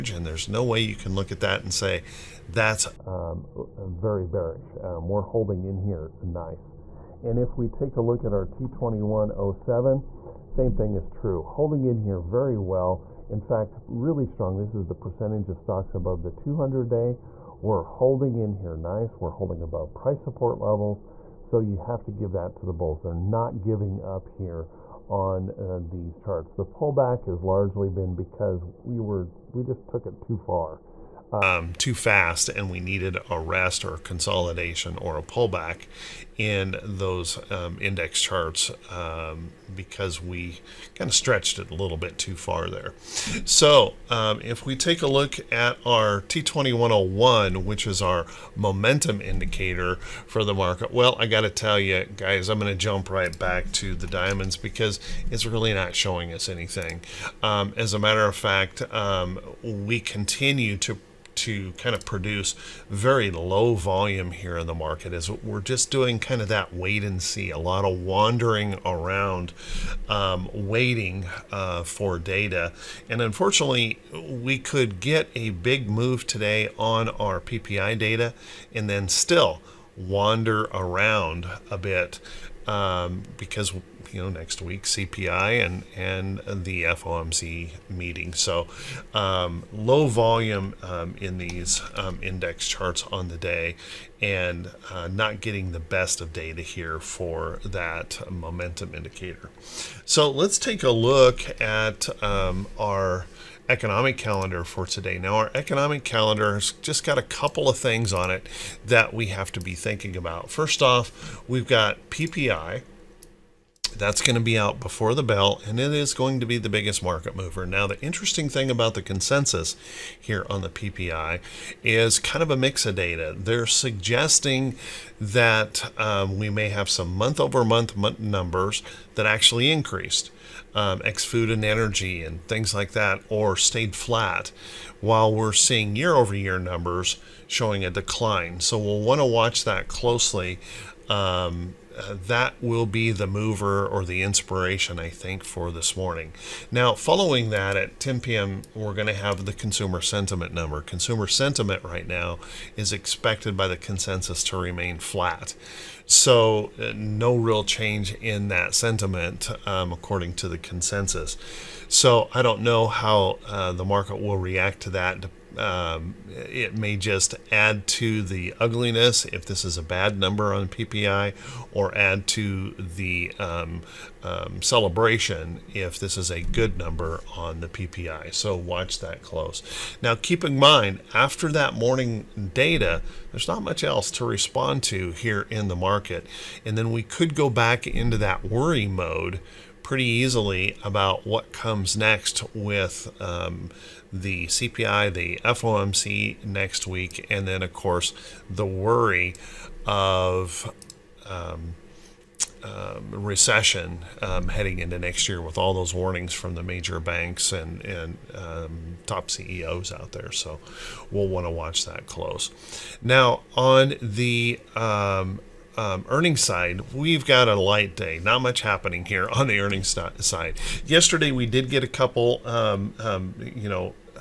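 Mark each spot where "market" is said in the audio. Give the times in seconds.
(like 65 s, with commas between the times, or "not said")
50 s, 64 s, 117 s, 163 s, 185 s.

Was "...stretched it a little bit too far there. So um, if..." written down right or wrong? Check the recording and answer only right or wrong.
right.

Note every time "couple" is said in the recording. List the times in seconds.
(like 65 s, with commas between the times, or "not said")
107 s, 221 s.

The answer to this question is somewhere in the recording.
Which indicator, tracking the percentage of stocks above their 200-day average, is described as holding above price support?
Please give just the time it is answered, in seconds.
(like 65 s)
8 s.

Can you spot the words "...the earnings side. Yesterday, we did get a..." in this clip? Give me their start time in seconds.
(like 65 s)
219 s.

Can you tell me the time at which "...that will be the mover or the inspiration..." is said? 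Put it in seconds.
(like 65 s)
142 s.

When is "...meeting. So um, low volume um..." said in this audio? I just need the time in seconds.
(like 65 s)
87 s.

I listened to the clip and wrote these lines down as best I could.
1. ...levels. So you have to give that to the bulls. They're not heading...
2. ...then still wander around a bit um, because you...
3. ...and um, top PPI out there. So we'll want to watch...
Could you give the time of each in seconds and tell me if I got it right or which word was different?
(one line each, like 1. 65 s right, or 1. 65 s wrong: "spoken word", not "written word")
1. 20 s wrong: "giving", not "heading"
2. 78 s right
3. 207 s wrong: "CEOs", not "PPI".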